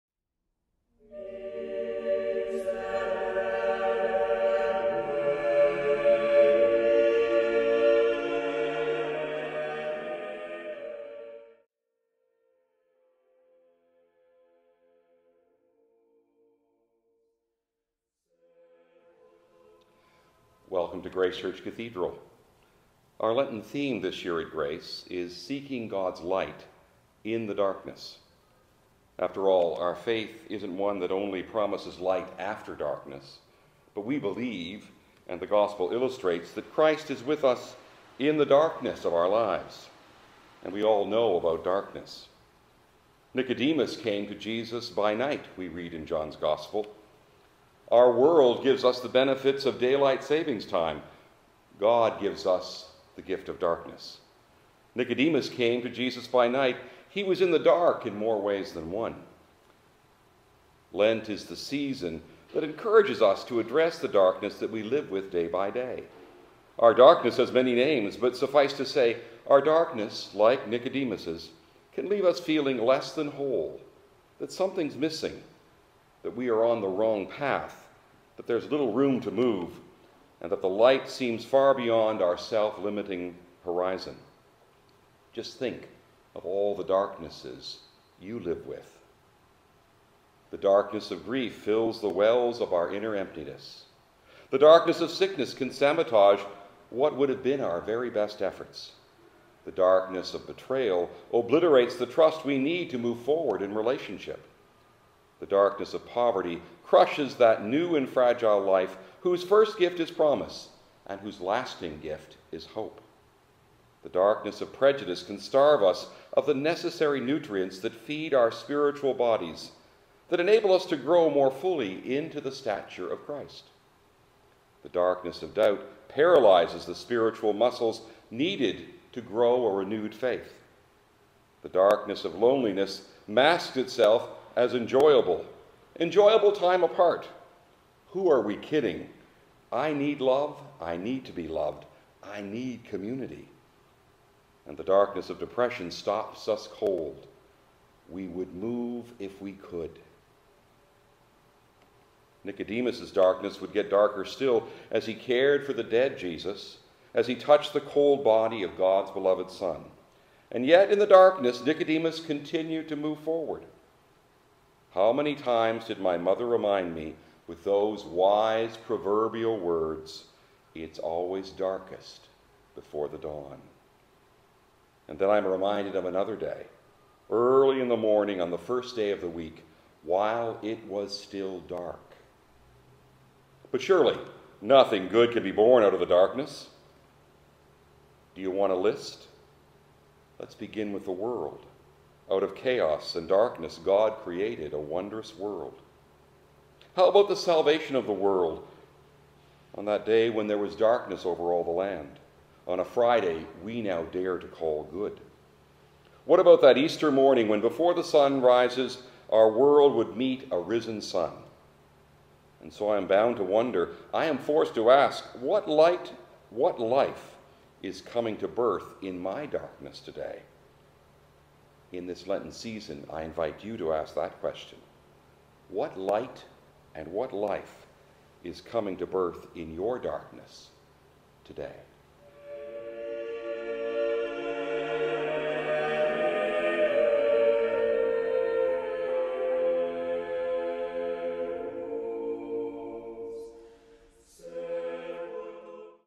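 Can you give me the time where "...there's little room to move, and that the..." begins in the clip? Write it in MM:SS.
01:18.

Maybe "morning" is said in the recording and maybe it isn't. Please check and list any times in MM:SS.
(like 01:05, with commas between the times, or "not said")
02:57, 03:27.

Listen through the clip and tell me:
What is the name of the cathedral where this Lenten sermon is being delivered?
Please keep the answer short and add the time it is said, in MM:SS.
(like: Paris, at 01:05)
Grace Church Cathedral, at 00:21.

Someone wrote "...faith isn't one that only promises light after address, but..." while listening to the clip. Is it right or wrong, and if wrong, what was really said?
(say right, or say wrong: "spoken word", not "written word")
wrong: "darkness", not "address".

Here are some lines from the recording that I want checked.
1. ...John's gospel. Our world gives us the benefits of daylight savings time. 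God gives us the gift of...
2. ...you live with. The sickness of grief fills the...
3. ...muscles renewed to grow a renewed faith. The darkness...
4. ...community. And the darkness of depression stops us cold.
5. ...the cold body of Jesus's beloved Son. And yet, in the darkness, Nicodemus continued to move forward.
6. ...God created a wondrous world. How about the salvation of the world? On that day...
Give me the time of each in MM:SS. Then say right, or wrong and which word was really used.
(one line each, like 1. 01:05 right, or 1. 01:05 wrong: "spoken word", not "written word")
1. 00:46 right
2. 01:28 wrong: "darkness", not "sickness"
3. 02:07 wrong: "needed", not "renewed"
4. 02:22 right
5. 02:37 wrong: "God", not "Jesus"
6. 03:13 right.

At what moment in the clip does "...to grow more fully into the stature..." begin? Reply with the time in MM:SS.
02:00.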